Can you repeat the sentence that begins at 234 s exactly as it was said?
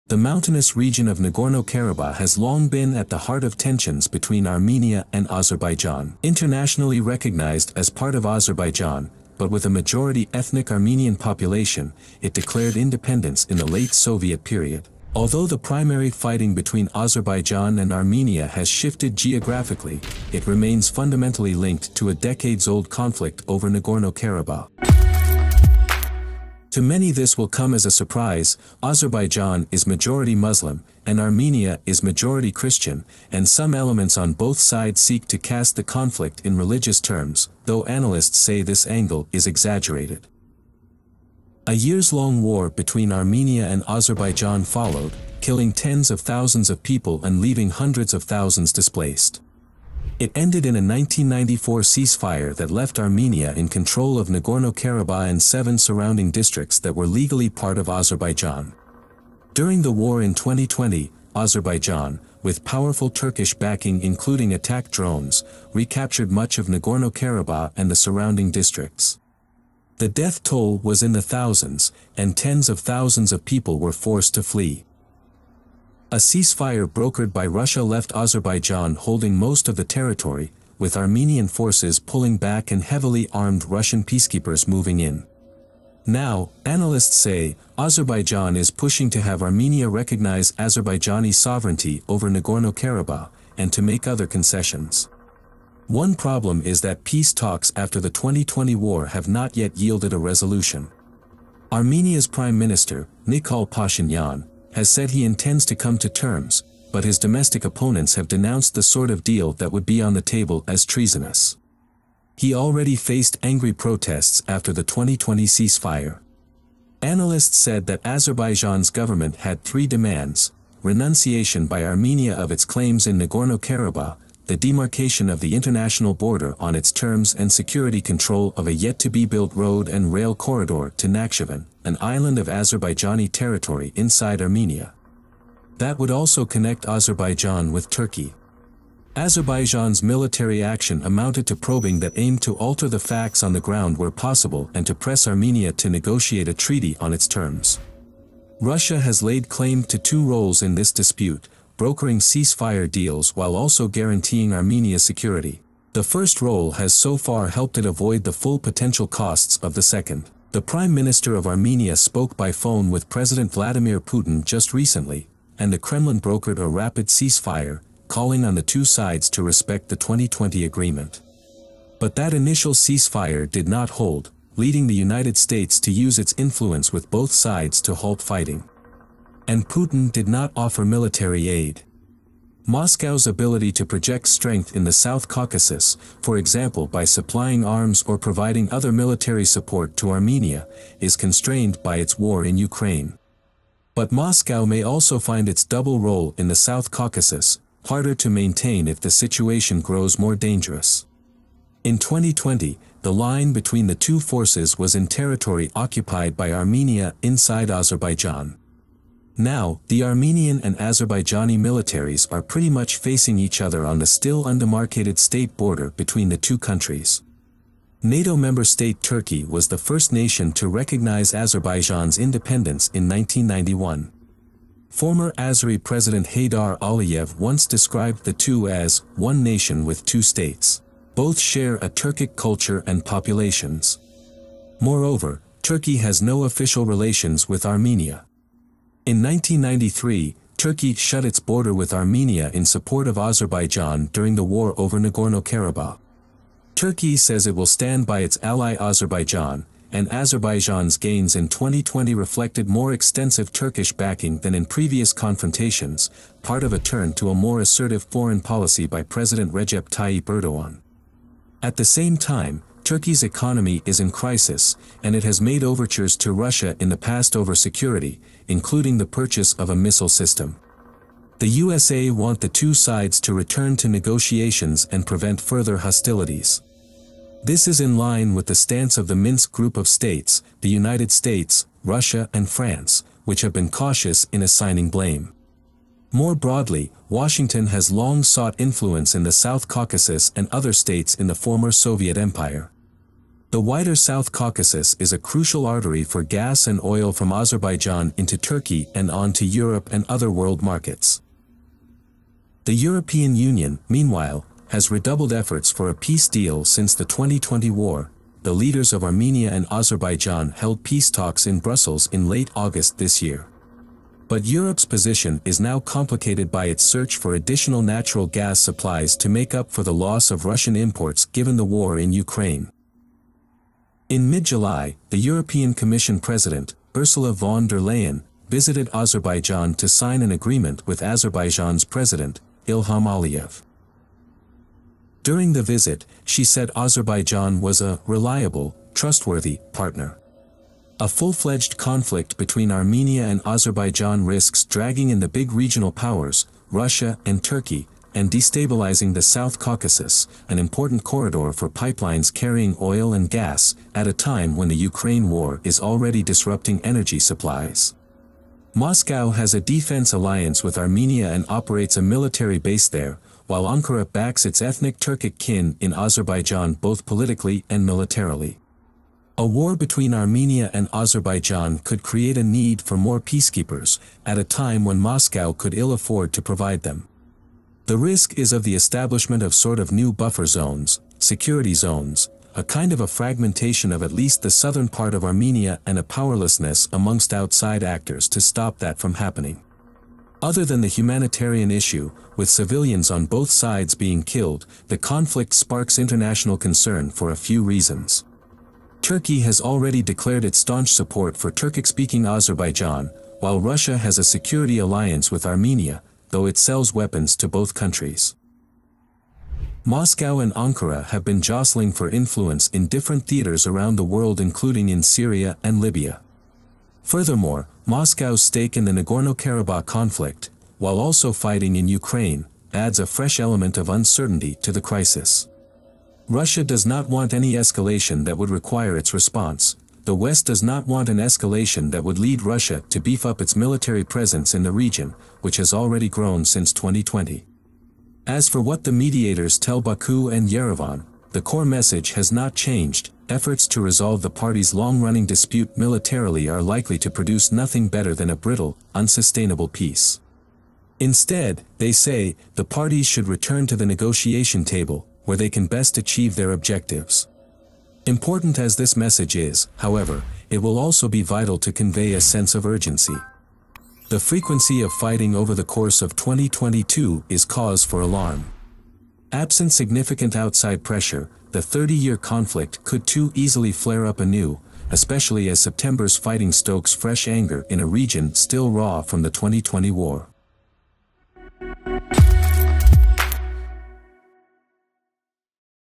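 Moreover, Turkey has no official relations with Armenia.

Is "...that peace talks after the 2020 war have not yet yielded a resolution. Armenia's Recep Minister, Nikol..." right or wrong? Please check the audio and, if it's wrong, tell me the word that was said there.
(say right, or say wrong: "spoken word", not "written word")
wrong: "Prime", not "Recep".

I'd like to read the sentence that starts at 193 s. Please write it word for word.
But Moscow may also find its double role in the South Caucasus, harder to maintain if the situation grows more dangerous.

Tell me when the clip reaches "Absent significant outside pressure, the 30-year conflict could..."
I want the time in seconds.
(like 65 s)
469 s.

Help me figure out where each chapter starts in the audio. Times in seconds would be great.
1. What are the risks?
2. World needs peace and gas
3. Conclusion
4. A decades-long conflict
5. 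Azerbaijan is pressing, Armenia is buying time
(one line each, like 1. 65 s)
1. 341 s
2. 271 s
3. 390 s
4. 26 s
5. 95 s.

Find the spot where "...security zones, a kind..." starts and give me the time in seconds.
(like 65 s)
381 s.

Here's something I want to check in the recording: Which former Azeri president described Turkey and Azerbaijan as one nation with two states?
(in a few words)
Haydar Aliyev.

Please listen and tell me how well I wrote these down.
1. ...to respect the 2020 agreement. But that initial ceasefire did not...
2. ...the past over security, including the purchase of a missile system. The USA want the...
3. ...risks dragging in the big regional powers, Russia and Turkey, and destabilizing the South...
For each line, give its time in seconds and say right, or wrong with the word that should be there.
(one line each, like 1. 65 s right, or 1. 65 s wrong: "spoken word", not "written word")
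1. 169 s right
2. 266 s right
3. 344 s right.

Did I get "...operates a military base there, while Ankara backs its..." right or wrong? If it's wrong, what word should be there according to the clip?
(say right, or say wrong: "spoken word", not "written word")
right.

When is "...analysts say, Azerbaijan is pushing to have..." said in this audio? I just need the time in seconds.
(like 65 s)
86 s.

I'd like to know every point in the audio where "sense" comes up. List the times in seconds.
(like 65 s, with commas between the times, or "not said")
462 s.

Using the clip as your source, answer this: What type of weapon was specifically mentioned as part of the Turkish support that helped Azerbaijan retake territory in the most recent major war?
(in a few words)
attack drones.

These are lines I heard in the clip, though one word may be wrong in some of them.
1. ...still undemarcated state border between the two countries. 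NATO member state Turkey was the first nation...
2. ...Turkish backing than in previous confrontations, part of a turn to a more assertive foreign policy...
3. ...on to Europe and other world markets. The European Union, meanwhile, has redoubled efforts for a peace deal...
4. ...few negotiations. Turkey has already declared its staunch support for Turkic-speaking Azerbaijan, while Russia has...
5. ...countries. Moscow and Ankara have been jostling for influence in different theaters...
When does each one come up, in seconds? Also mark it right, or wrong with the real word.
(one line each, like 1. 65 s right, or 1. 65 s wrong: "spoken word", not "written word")
1. 214 s right
2. 253 s right
3. 299 s right
4. 397 s wrong: "reasons", not "negotiations"
5. 407 s right.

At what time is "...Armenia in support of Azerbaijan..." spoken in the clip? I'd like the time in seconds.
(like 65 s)
241 s.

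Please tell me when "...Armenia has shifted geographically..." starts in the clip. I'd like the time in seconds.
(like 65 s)
17 s.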